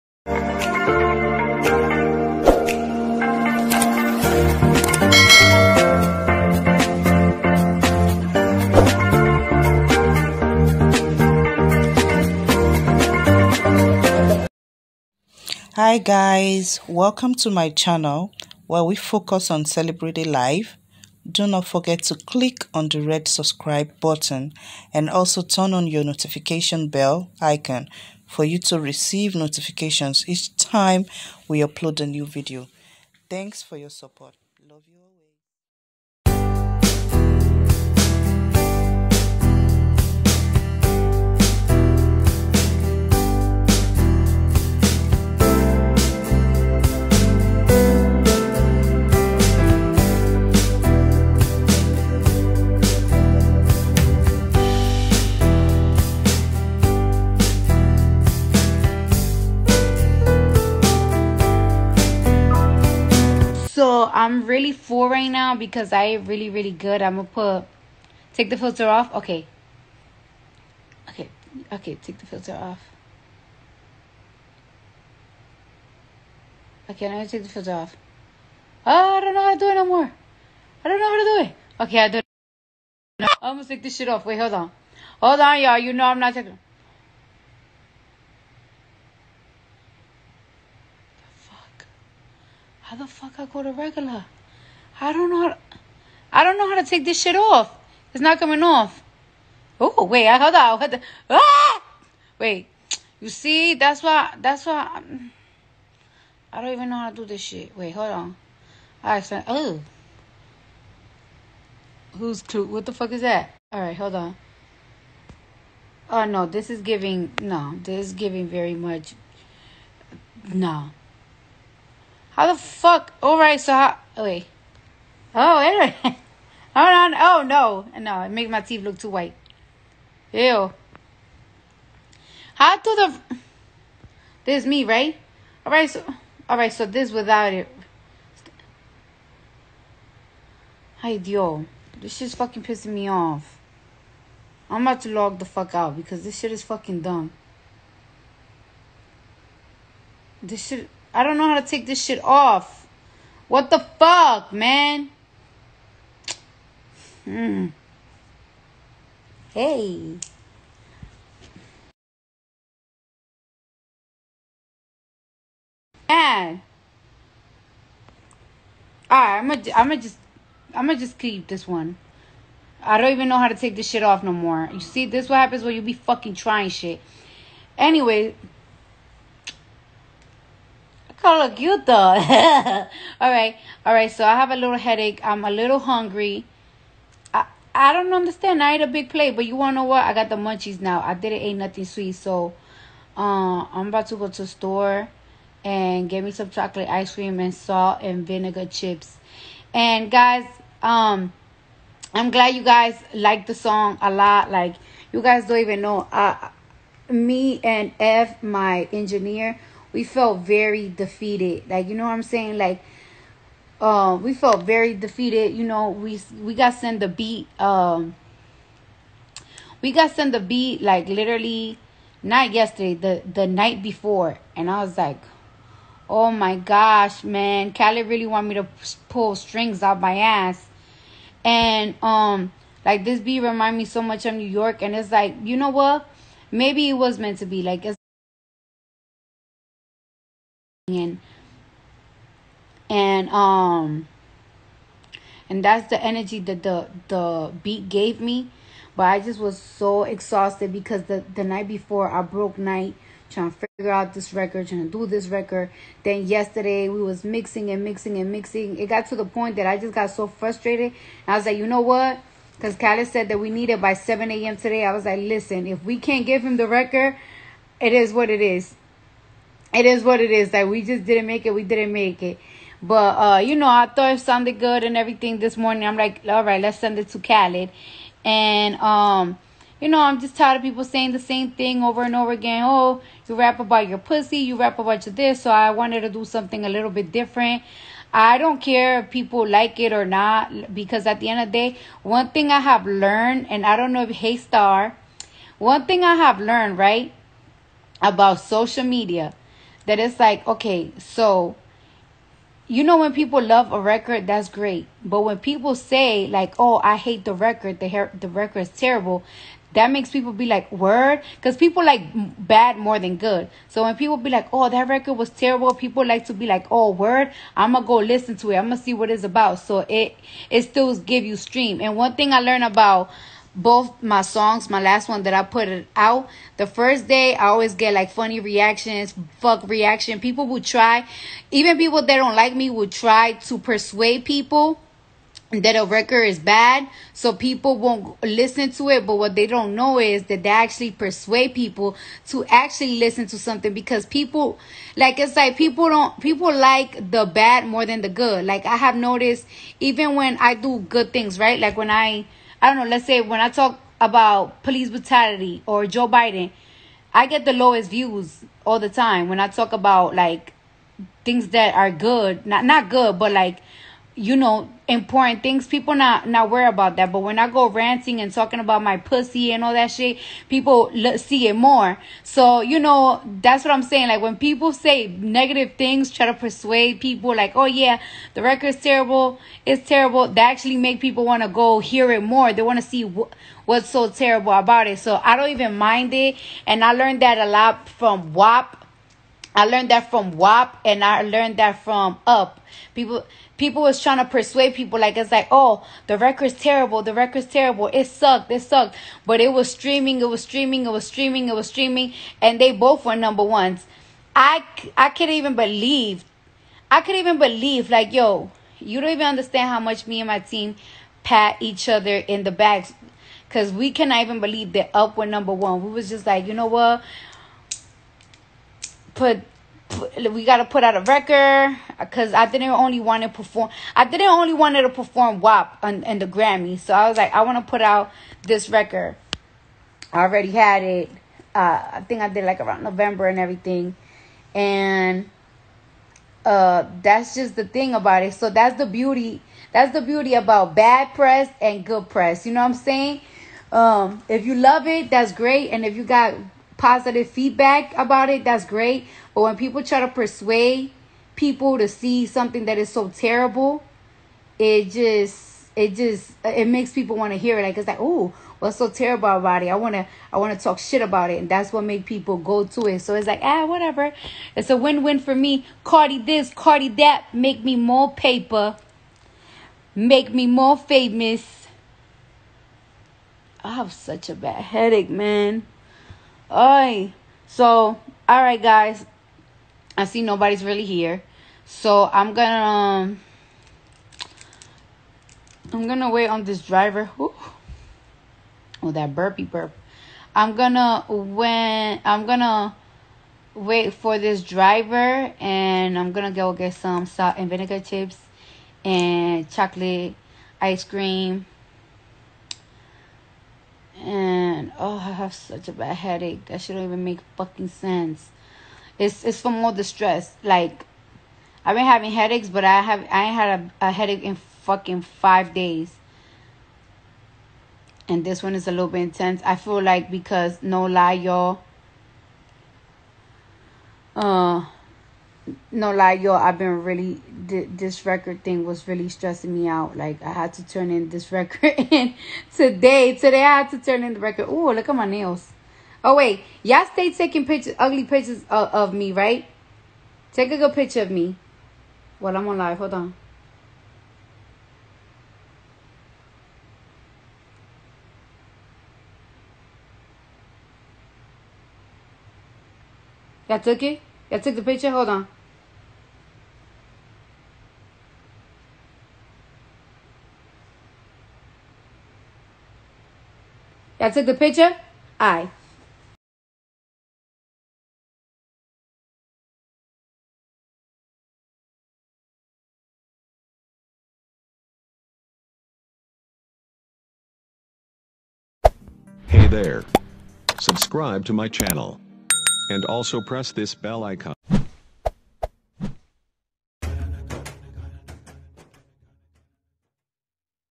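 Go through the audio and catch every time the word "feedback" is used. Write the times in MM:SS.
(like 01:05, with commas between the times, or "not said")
07:27.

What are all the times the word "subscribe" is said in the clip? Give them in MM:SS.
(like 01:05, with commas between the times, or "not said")
00:23, 09:40.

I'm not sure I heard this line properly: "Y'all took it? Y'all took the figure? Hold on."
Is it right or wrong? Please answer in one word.
wrong.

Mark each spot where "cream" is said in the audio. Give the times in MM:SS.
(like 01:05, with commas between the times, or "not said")
03:17, 08:20.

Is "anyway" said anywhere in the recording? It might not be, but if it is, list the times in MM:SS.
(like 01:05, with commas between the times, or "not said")
02:05, 02:57.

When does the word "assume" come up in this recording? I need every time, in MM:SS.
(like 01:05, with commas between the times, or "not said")
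not said.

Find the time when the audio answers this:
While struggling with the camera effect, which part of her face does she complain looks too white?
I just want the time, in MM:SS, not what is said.
02:08.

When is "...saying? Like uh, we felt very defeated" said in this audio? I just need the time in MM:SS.
03:32.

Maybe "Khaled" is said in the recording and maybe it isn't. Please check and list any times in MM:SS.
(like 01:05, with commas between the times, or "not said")
03:47, 04:22, 04:37.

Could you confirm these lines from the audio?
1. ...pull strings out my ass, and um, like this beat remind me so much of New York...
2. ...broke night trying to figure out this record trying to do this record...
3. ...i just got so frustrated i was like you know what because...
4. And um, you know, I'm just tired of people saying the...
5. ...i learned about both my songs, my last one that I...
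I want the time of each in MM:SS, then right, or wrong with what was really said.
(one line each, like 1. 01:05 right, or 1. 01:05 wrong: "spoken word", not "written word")
1. 03:49 right
2. 04:12 right
3. 04:19 right
4. 04:38 right
5. 05:22 right.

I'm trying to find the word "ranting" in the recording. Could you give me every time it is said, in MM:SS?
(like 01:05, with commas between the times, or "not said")
06:07.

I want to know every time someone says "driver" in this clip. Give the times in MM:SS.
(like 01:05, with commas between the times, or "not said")
08:06, 08:14.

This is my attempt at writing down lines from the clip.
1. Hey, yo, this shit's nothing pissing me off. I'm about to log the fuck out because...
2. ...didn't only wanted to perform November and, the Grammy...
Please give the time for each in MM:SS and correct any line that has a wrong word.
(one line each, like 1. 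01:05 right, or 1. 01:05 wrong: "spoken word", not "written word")
1. 02:21 wrong: "fucking", not "nothing"
2. 07:04 wrong: "WAP", not "November".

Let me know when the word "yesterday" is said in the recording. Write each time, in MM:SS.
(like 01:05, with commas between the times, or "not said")
03:42, 04:16.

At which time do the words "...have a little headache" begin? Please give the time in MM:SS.
03:04.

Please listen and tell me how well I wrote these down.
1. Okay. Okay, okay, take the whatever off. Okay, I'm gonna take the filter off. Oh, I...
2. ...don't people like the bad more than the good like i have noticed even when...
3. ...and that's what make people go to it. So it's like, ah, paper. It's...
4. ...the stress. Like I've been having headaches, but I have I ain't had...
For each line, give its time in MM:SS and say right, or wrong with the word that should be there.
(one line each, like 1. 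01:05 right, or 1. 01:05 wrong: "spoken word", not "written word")
1. 01:09 wrong: "filter", not "whatever"
2. 05:45 right
3. 07:41 wrong: "whatever", not "paper"
4. 08:29 right.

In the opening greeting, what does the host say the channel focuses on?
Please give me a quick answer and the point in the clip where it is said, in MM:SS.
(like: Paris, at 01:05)
celebrating life, at 00:19.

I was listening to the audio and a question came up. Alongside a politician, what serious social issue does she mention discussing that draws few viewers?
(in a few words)
police brutality.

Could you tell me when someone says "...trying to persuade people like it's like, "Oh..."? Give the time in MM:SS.
06:34.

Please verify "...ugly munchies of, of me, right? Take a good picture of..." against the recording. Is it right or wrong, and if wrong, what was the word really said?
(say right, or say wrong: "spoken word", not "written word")
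wrong: "pictures", not "munchies".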